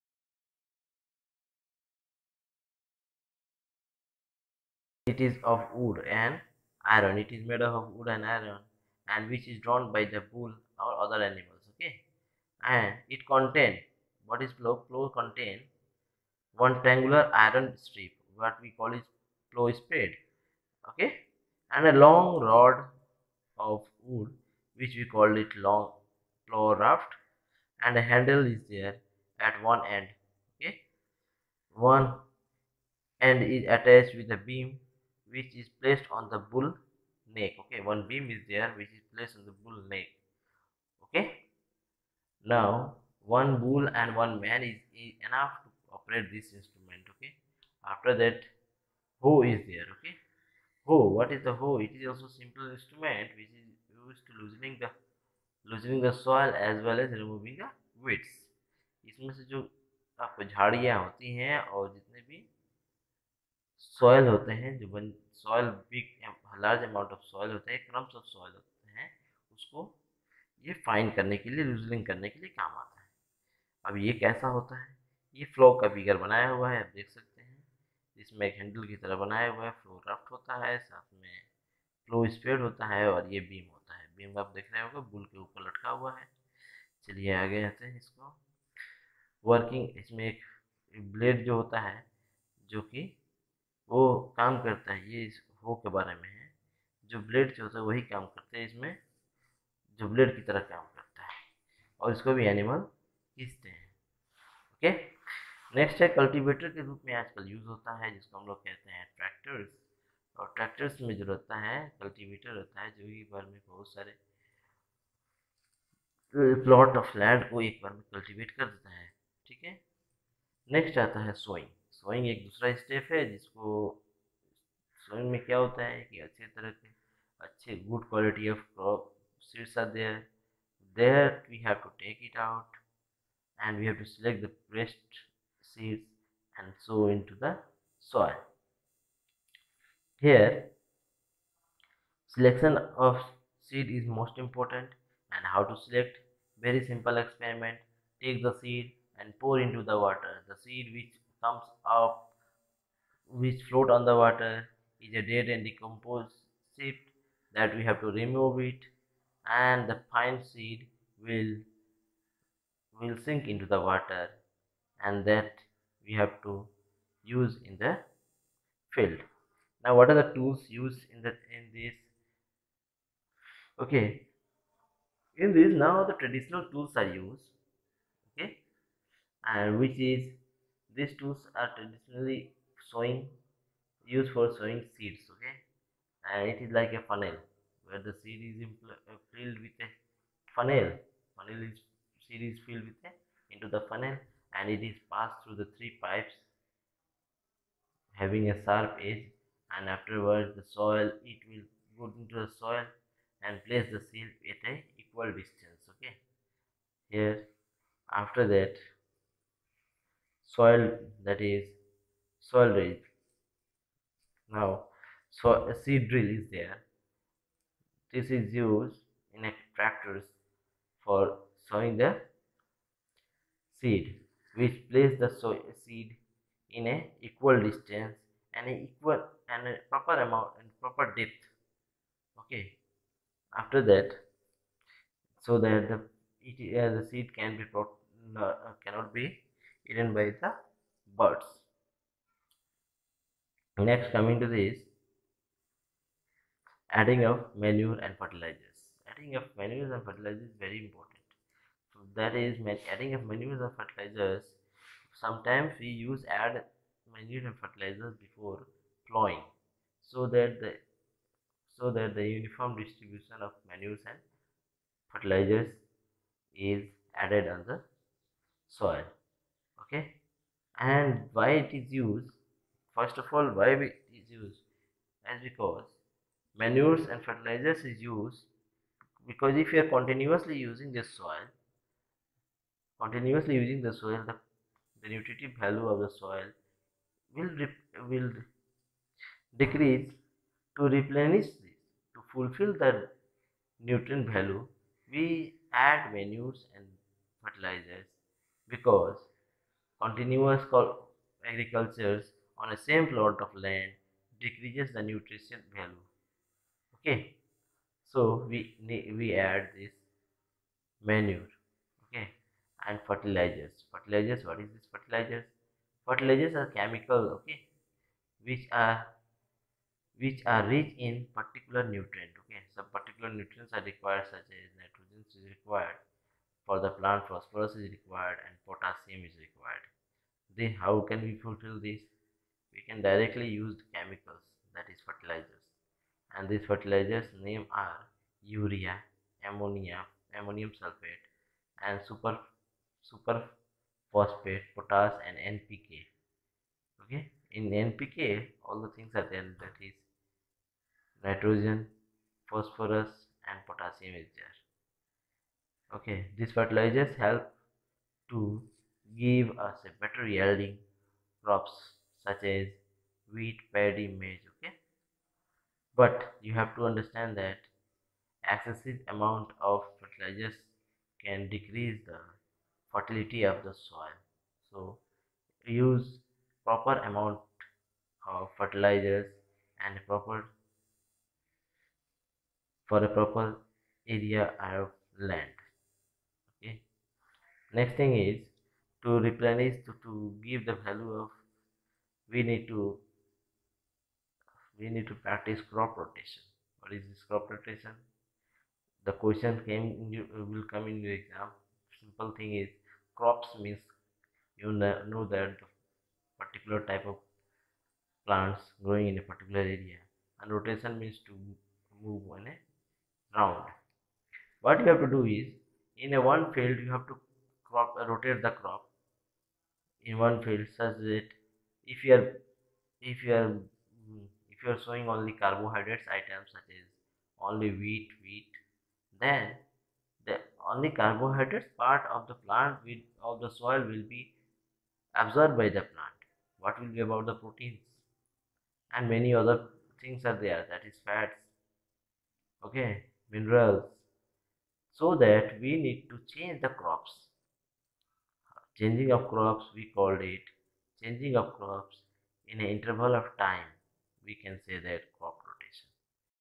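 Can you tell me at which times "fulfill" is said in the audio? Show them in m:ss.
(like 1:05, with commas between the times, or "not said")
4:52, 5:31.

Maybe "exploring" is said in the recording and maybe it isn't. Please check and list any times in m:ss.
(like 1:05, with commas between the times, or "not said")
not said.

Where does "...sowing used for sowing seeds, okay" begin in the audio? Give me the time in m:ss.
3:02.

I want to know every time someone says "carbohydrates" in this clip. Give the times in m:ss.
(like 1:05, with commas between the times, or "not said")
7:05, 7:10.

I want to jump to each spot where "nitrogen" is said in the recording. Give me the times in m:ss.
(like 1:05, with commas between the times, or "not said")
5:24, 5:51.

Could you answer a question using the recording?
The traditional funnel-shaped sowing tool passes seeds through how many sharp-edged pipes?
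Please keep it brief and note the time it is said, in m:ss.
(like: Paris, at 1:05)
3, at 3:15.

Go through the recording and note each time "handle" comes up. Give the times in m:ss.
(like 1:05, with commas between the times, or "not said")
0:28.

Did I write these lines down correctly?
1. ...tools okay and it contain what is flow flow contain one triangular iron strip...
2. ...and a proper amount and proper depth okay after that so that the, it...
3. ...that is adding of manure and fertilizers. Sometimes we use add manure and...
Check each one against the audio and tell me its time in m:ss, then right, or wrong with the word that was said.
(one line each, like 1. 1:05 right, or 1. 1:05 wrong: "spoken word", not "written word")
1. 0:11 wrong: "animals", not "tools"
2. 3:49 right
3. 4:12 right.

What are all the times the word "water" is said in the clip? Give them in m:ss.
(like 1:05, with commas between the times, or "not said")
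2:29, 2:34, 2:43.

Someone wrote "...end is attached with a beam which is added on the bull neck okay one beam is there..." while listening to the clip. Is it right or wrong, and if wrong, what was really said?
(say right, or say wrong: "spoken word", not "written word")
wrong: "placed", not "added".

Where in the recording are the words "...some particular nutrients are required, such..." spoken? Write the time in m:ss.
5:22.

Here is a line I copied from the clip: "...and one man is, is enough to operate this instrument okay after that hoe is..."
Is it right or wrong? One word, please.
right.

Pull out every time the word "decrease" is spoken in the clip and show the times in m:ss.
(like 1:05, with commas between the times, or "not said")
4:49, 5:04, 6:11.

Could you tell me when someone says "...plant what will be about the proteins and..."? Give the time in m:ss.
7:15.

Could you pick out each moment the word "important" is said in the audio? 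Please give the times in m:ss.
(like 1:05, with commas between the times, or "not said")
2:24, 4:10.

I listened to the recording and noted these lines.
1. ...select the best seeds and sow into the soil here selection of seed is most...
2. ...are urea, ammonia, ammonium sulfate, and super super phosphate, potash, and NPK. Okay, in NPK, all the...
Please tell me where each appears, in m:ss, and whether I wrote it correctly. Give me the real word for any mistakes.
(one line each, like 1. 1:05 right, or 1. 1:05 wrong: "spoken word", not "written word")
1. 2:14 right
2. 5:37 right.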